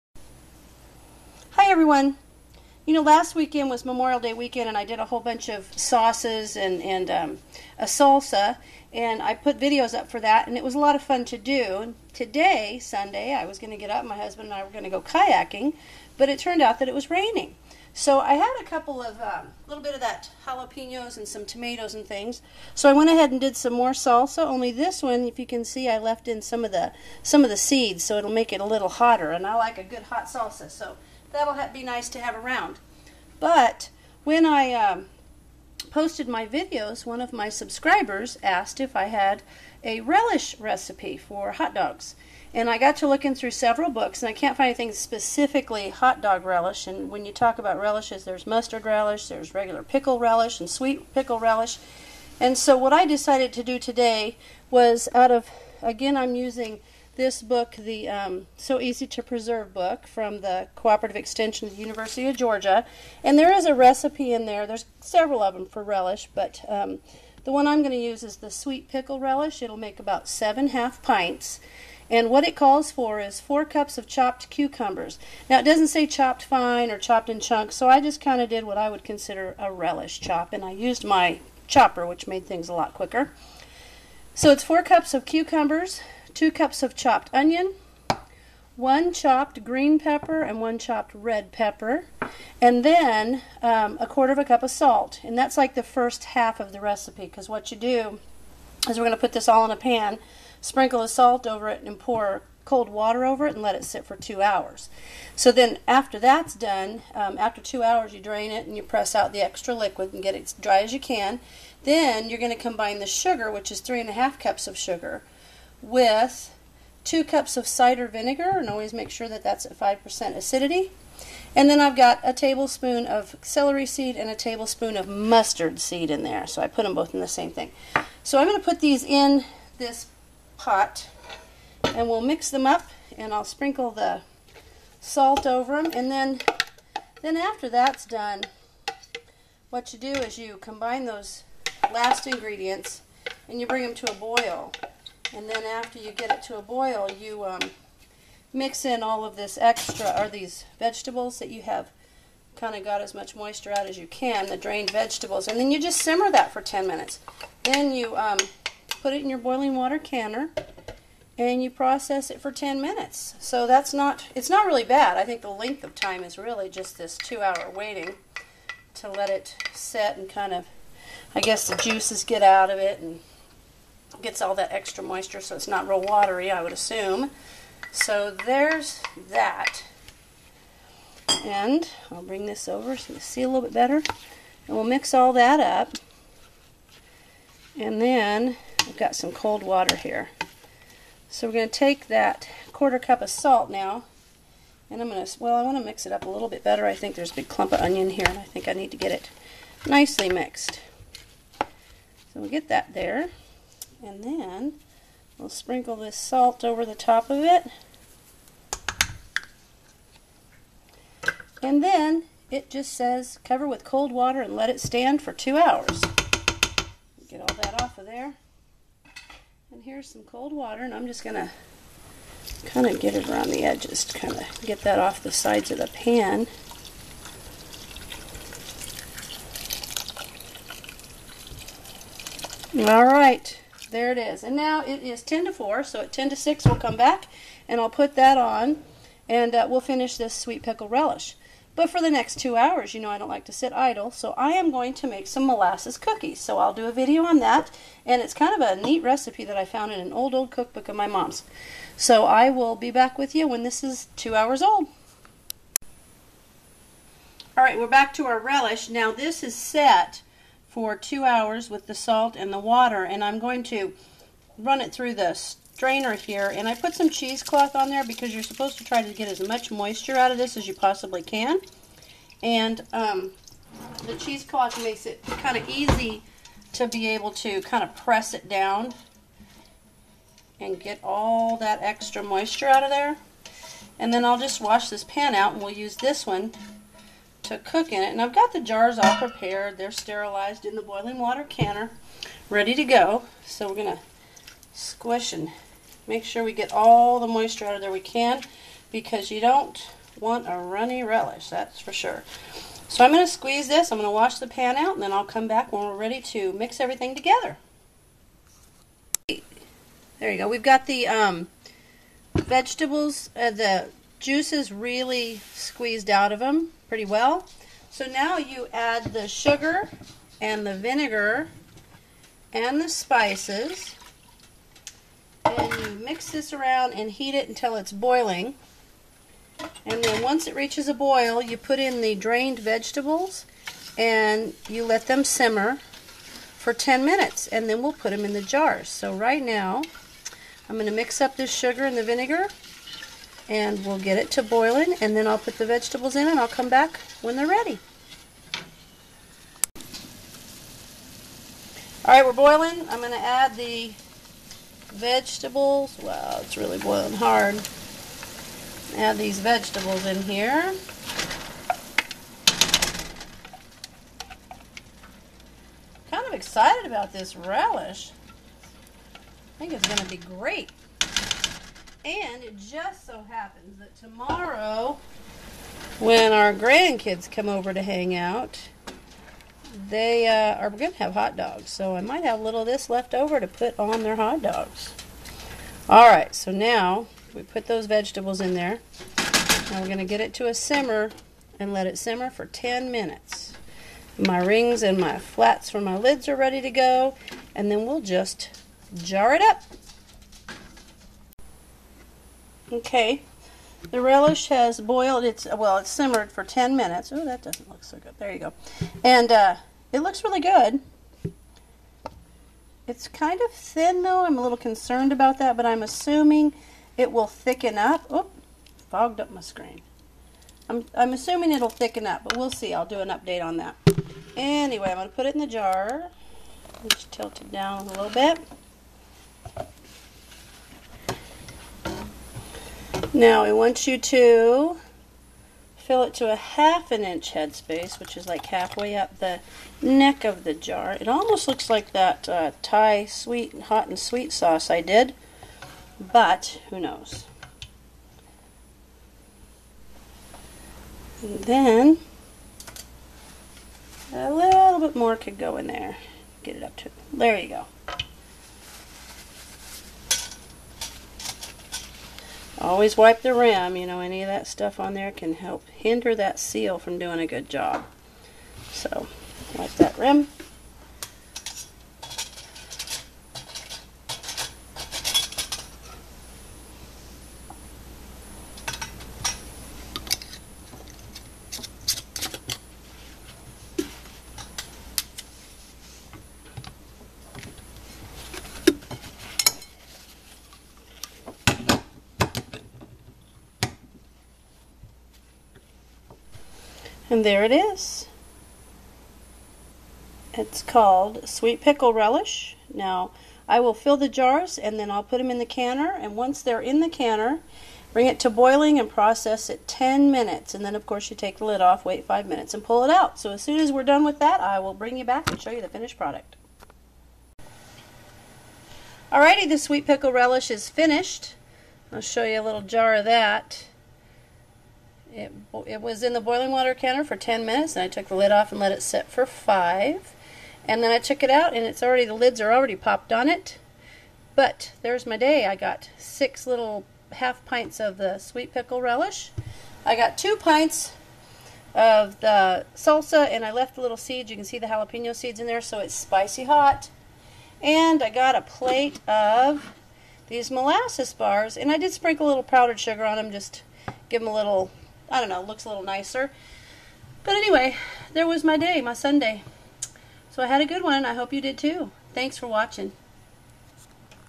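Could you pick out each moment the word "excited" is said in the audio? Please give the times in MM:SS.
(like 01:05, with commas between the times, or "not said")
06:06.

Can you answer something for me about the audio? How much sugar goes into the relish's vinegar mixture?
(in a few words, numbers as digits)
3 and a half cups.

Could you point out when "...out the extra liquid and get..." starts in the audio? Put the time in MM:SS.
01:49.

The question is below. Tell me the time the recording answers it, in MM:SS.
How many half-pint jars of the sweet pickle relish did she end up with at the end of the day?
08:55.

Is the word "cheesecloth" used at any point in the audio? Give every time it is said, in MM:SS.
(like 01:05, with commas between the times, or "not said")
04:27, 04:34.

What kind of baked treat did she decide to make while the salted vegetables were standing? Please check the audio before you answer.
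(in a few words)
molasses cookies.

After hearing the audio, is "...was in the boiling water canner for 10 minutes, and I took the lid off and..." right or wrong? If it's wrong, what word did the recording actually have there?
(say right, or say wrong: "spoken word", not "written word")
right.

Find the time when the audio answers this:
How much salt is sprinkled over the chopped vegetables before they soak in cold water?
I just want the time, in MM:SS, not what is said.
01:33.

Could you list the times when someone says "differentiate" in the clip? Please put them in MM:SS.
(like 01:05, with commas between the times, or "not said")
not said.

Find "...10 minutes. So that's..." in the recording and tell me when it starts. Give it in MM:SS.
02:42.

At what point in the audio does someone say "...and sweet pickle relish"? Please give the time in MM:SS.
00:50.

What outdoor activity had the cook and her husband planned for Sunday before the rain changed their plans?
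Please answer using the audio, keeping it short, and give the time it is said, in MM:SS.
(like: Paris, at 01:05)
kayaking, at 00:15.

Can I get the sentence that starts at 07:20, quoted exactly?
It almost looks like that uh, Thai sweet hot and sweet sauce I did, but who knows.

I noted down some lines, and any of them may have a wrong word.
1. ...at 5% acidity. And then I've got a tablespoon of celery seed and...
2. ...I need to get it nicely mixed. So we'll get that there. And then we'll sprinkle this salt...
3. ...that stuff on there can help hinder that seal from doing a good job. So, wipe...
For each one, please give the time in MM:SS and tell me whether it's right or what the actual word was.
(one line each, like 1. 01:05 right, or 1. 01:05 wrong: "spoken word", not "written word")
1. 01:59 right
2. 03:18 right
3. 07:44 right.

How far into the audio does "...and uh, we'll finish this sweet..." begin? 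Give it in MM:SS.
03:59.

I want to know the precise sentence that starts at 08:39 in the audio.
Alrighty, the sweet pickle relish is finished.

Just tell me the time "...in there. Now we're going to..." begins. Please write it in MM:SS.
06:28.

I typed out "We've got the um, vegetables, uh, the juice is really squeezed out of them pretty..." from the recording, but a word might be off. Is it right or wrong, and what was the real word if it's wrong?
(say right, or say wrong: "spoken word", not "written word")
right.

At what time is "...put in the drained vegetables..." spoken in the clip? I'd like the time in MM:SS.
05:31.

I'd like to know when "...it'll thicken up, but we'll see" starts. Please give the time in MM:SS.
07:01.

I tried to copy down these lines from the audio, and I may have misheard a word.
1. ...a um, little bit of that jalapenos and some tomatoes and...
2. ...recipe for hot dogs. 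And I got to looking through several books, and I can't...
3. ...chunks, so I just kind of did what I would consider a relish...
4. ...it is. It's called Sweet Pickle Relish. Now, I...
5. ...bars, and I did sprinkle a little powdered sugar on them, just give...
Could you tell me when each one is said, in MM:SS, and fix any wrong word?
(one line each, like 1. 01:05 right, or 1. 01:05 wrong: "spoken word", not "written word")
1. 00:19 right
2. 00:40 right
3. 01:17 right
4. 08:17 right
5. 09:11 right.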